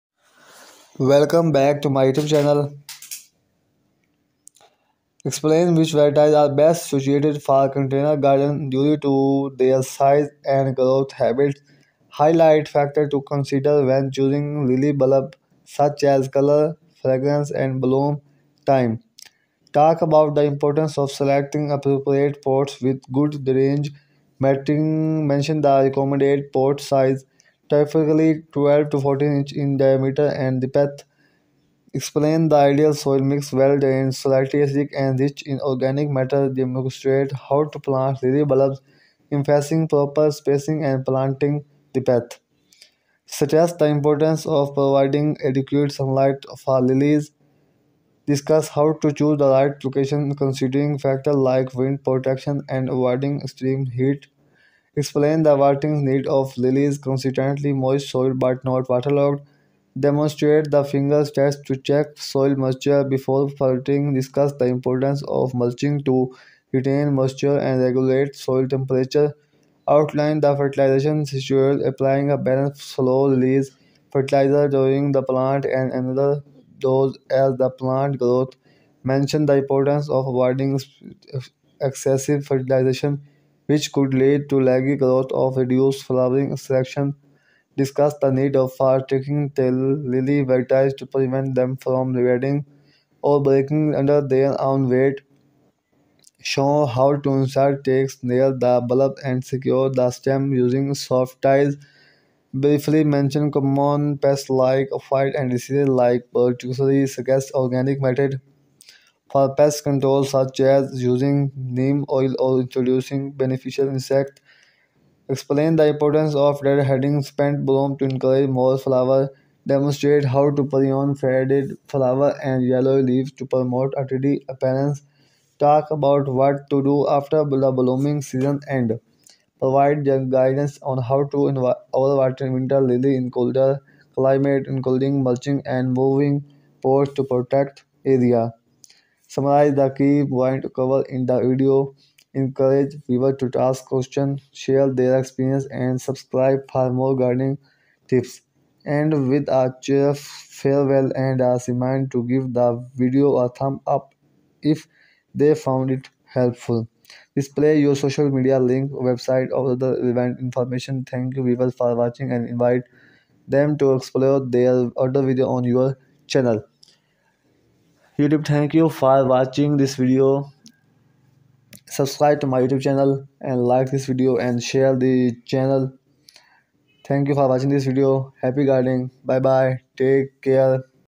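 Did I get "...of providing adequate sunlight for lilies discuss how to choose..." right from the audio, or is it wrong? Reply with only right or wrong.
right.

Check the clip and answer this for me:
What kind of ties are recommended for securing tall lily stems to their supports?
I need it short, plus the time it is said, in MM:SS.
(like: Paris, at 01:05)
Soft ties, at 01:41.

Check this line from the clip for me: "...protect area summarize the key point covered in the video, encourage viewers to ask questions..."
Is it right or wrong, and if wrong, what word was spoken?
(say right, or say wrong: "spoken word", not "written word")
right.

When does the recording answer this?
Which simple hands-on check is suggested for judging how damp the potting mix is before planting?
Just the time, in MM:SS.
01:00.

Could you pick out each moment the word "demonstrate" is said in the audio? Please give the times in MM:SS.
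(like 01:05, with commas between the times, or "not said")
00:36, 00:59, 01:59.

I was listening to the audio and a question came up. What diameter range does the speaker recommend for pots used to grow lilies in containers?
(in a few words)
12 to 14 inches.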